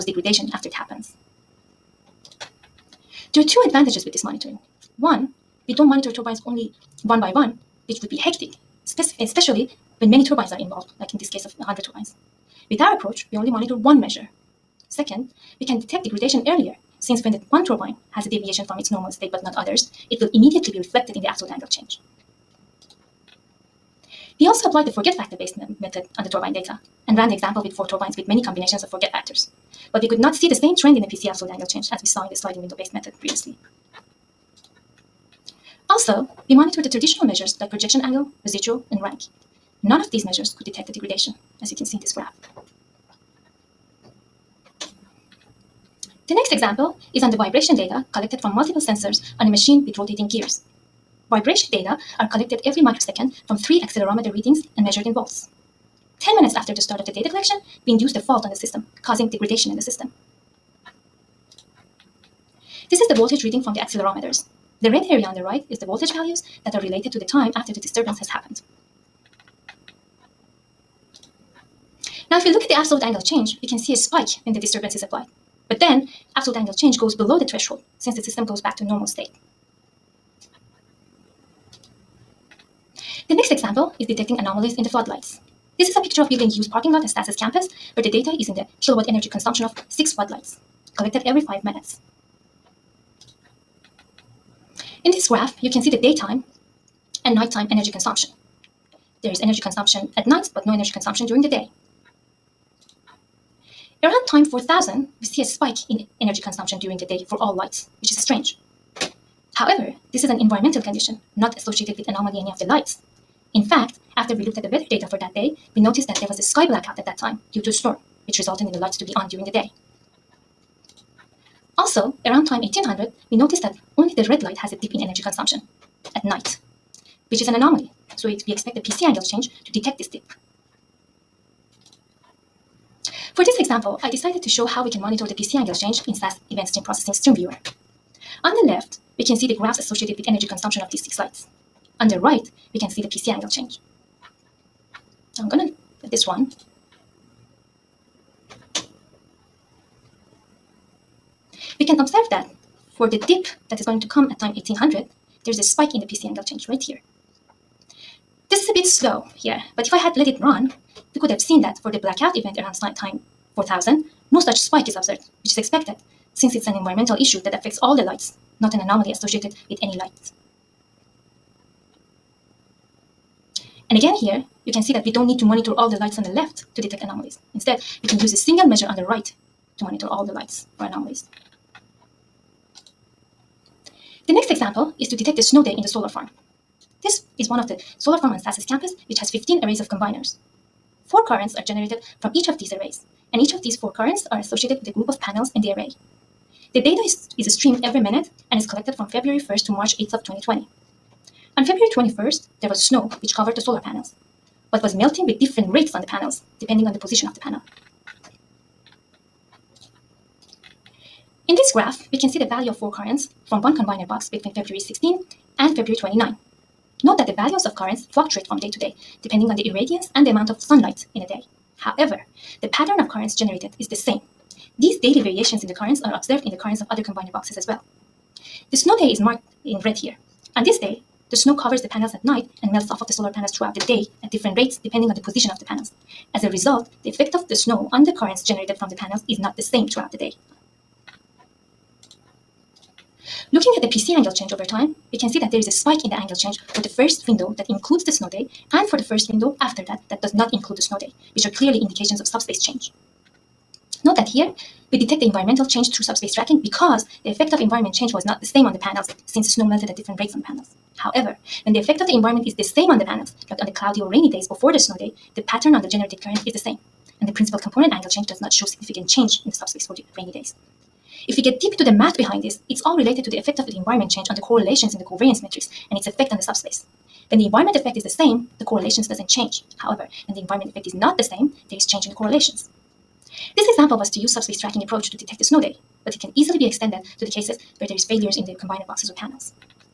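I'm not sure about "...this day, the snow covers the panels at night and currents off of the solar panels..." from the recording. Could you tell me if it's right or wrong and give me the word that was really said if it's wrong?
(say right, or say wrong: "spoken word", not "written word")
wrong: "melts", not "currents".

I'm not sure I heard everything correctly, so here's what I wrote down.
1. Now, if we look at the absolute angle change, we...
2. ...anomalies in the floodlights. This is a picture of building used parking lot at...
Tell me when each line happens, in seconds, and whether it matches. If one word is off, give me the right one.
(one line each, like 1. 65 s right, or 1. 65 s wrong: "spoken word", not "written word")
1. 72 s right
2. 84 s right.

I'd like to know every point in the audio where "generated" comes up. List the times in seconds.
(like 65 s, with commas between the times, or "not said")
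191 s, 223 s, 238 s, 265 s.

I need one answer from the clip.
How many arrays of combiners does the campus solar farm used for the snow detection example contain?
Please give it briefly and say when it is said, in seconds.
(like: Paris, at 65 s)
15, at 189 s.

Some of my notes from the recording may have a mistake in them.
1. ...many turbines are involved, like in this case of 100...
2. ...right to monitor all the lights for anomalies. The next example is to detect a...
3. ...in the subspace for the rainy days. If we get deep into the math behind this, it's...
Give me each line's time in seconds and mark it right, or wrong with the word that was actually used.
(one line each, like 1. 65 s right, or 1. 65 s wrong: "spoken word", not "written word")
1. 10 s right
2. 179 s right
3. 269 s right.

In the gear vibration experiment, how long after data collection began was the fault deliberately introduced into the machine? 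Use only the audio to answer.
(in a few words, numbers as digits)
10 minutes.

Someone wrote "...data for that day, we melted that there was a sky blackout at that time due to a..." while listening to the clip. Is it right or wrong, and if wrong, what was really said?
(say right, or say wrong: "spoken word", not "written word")
wrong: "noticed", not "melted".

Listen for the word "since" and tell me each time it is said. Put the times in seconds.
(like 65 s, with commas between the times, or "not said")
17 s, 77 s, 166 s, 259 s.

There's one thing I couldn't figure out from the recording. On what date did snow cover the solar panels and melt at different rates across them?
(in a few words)
February 21st.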